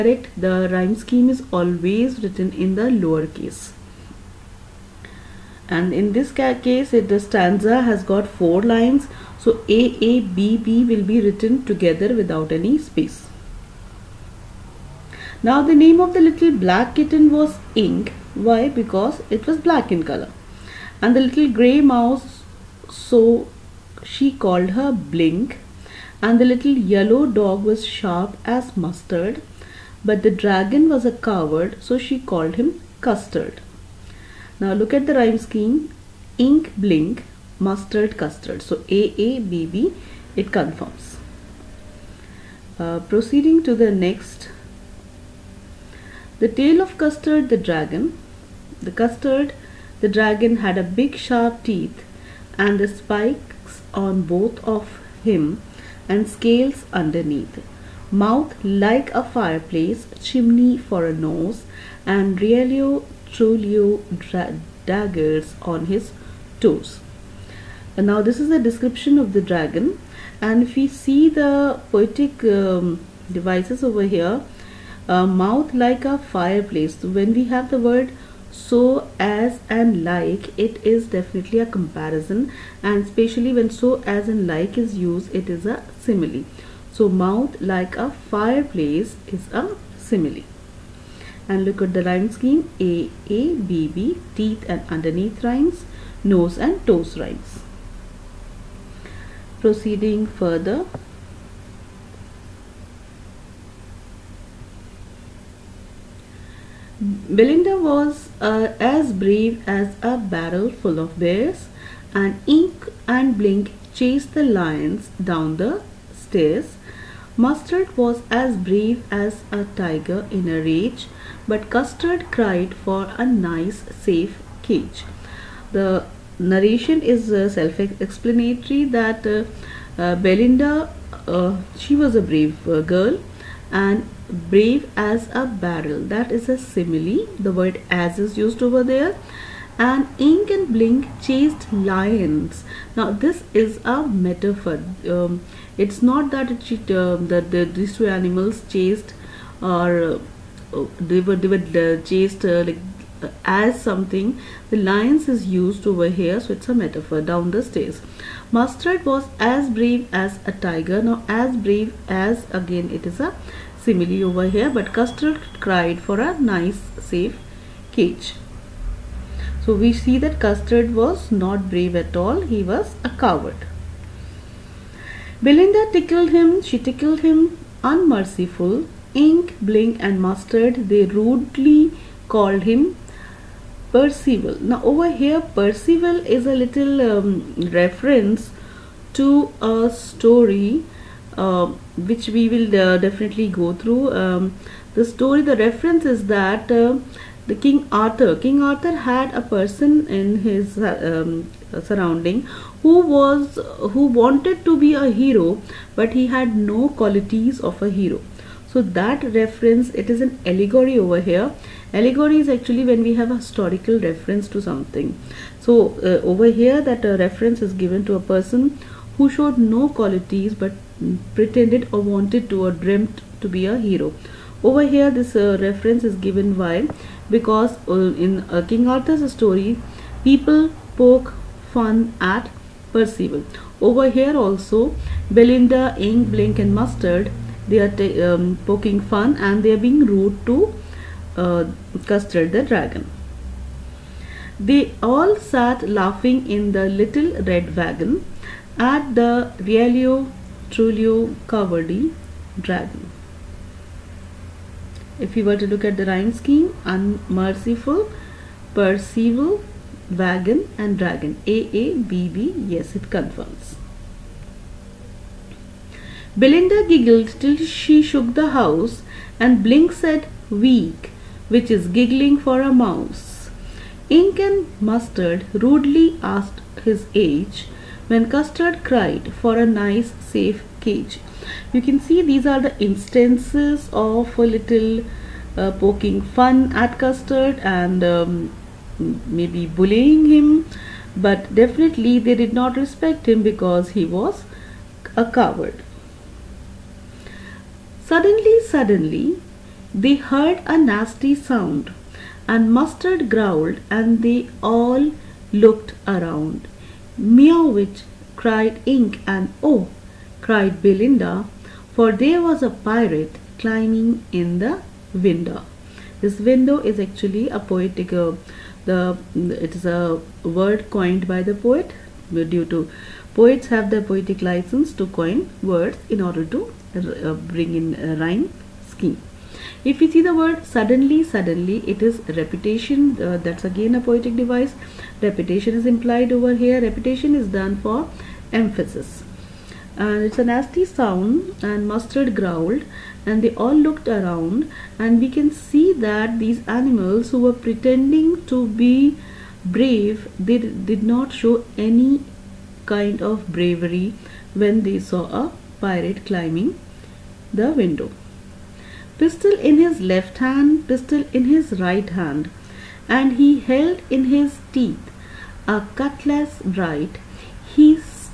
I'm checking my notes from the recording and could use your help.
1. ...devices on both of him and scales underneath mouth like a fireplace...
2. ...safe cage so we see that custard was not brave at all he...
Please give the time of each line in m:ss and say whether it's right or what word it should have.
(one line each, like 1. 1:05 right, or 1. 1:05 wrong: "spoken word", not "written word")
1. 0:52 wrong: "spikes", not "devices"
2. 2:47 right.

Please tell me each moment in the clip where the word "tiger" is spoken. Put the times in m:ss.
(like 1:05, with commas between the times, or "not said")
1:59, 2:40.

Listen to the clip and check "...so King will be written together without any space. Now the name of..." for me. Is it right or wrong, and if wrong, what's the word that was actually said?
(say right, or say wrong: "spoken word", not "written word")
wrong: "AABB", not "King".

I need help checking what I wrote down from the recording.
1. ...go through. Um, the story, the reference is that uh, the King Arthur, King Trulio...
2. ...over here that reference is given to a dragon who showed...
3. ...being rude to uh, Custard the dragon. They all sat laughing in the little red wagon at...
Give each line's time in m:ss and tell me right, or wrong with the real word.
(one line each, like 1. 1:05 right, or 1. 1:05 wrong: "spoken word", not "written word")
1. 3:13 wrong: "Arthur", not "Trulio"
2. 3:36 wrong: "person", not "dragon"
3. 3:59 right.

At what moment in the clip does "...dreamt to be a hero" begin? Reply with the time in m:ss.
3:42.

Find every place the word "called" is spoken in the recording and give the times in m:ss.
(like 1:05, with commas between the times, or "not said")
0:24, 0:32, 3:02.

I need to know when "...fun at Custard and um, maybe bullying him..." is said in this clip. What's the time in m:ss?
4:46.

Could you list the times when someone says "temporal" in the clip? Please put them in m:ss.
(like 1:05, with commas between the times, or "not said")
not said.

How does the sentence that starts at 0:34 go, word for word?
Now look at the rhyme scheme.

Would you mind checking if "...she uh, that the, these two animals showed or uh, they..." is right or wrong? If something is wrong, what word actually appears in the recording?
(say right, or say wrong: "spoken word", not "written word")
wrong: "chased", not "showed".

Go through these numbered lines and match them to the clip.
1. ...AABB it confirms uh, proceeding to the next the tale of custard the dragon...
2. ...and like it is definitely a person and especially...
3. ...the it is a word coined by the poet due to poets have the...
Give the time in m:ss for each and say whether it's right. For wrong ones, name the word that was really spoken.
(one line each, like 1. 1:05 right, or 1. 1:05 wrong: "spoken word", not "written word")
1. 0:38 right
2. 1:19 wrong: "comparison", not "person"
3. 5:18 right.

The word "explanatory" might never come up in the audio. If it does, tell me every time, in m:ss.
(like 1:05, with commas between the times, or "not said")
2:07.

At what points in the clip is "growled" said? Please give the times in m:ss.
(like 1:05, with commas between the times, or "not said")
5:03, 5:42.